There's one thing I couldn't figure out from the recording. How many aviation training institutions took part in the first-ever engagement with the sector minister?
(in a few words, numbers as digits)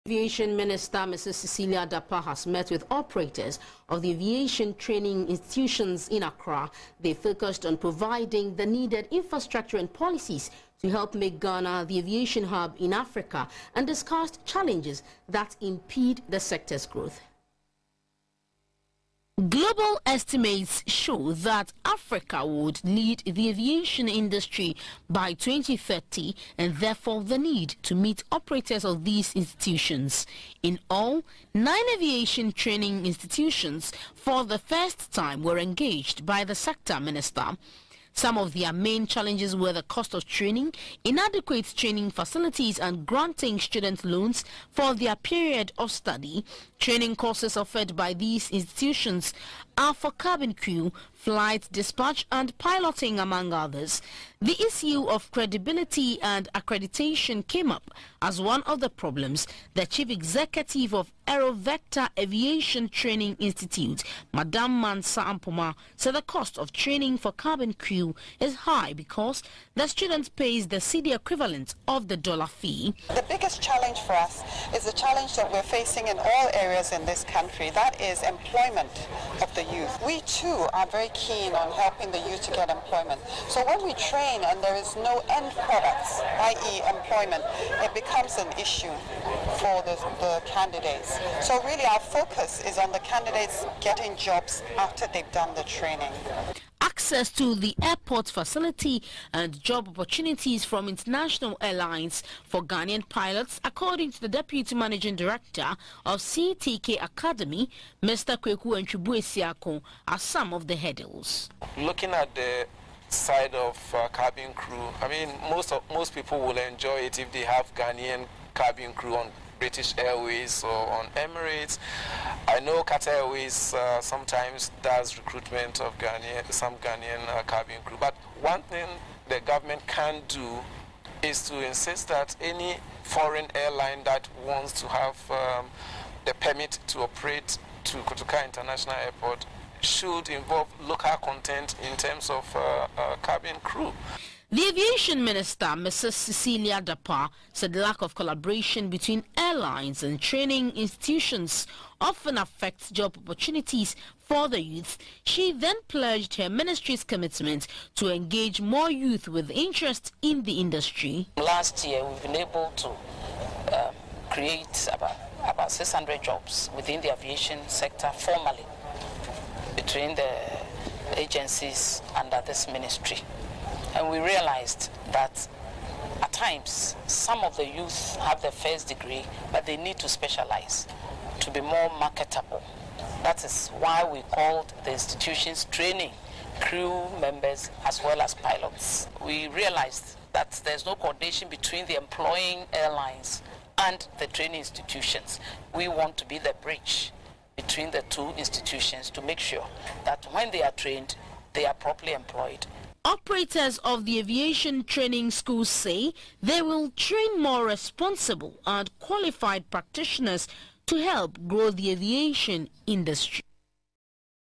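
9.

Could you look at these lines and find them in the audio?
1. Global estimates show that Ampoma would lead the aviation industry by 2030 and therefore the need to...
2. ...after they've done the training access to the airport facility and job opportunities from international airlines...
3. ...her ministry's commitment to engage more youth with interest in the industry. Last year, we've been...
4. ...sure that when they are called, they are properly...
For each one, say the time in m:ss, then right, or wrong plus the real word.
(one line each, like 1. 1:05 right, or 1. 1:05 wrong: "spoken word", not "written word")
1. 0:19 wrong: "Africa", not "Ampoma"
2. 1:34 right
3. 2:36 right
4. 3:19 wrong: "trained", not "called".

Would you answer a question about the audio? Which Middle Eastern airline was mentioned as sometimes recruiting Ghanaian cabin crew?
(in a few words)
Qatar Airways.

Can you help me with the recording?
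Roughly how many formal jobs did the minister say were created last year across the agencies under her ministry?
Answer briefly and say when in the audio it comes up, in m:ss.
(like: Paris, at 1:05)
600, at 2:45.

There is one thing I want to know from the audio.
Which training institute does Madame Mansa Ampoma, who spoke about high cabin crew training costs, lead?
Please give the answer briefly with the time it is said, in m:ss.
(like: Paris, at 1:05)
Aerovector Aviation Training Institute, at 1:01.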